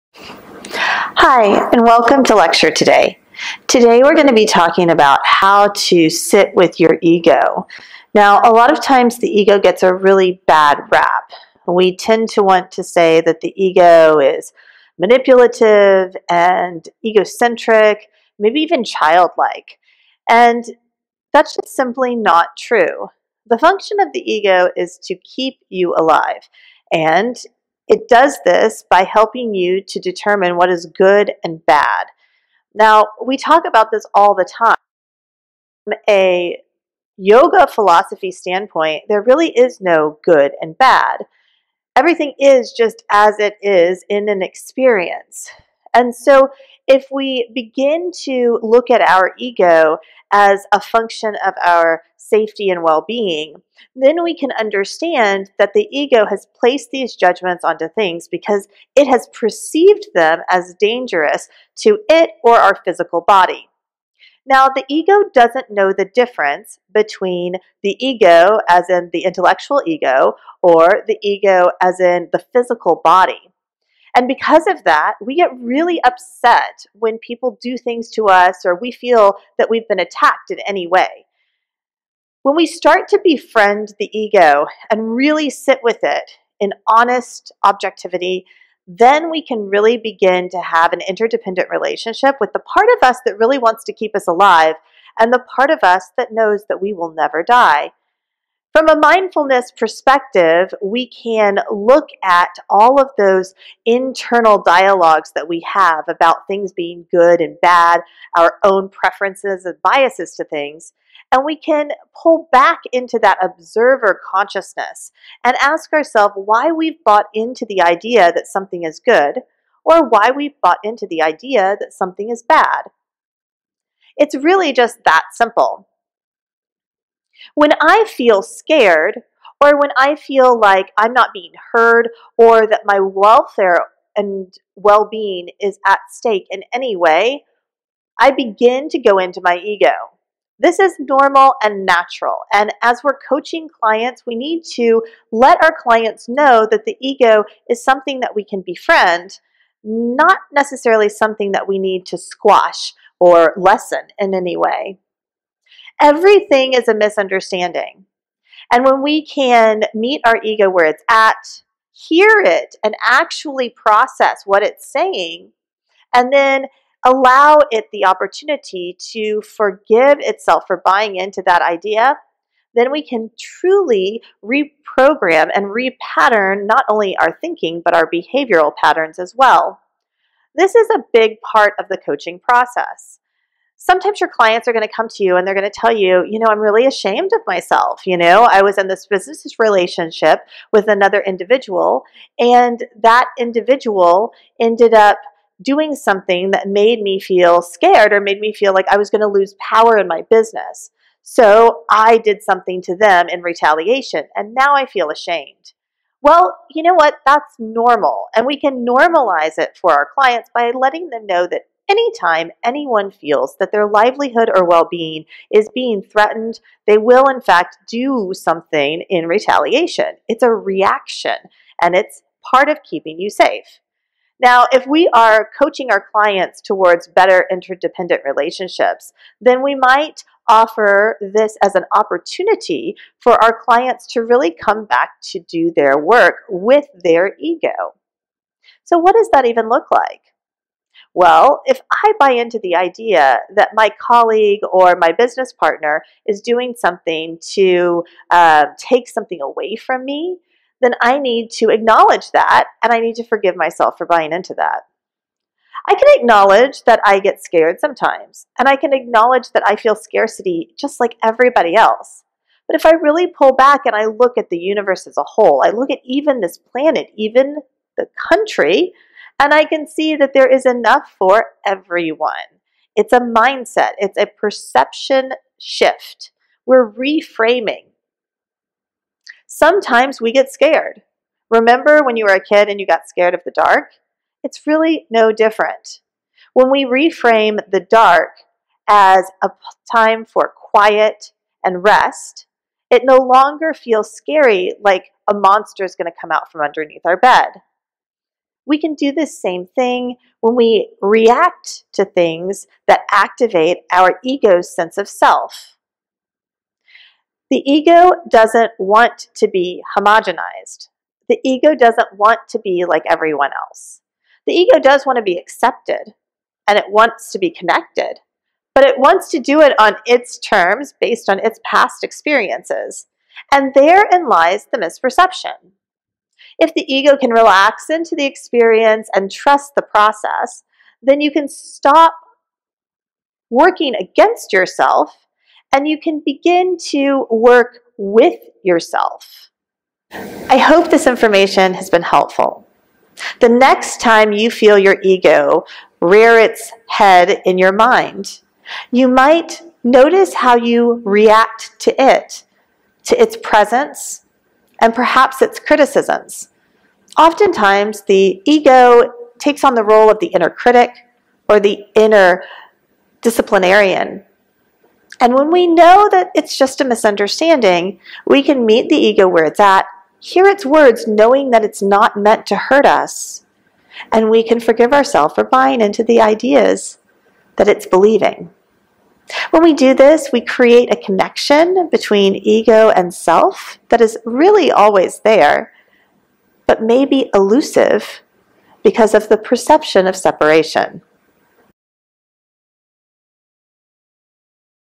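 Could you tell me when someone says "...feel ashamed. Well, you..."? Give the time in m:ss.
3:24.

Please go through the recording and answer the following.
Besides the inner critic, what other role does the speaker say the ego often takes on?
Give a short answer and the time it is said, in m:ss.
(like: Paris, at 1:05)
Inner disciplinarian, at 6:01.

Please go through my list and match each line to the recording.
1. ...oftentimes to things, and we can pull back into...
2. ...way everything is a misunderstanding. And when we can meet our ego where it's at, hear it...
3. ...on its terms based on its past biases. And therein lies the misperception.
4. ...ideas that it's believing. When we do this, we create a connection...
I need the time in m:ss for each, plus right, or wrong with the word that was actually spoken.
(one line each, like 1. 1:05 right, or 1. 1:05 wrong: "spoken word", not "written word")
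1. 1:49 wrong: "biases", not "oftentimes"
2. 2:34 right
3. 5:19 wrong: "experiences", not "biases"
4. 6:16 right.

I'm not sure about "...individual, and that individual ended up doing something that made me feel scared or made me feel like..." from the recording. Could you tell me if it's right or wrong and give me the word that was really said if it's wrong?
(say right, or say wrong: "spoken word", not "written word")
right.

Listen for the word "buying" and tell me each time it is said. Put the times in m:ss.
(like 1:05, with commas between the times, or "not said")
2:50, 4:14, 6:15.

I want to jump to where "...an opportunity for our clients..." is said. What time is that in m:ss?
3:51.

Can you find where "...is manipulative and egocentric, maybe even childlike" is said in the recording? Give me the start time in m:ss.
0:14.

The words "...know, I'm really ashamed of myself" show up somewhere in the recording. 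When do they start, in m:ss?
3:06.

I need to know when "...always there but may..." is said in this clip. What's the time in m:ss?
6:24.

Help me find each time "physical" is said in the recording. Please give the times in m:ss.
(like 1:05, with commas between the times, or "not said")
1:02, 1:12.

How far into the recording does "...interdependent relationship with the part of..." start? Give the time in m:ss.
1:31.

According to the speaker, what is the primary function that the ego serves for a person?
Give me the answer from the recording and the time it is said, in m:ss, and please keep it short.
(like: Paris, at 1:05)
To keep you alive, at 0:25.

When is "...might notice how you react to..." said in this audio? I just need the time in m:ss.
5:49.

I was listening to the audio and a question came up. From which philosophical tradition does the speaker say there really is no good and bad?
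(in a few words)
Yoga philosophy.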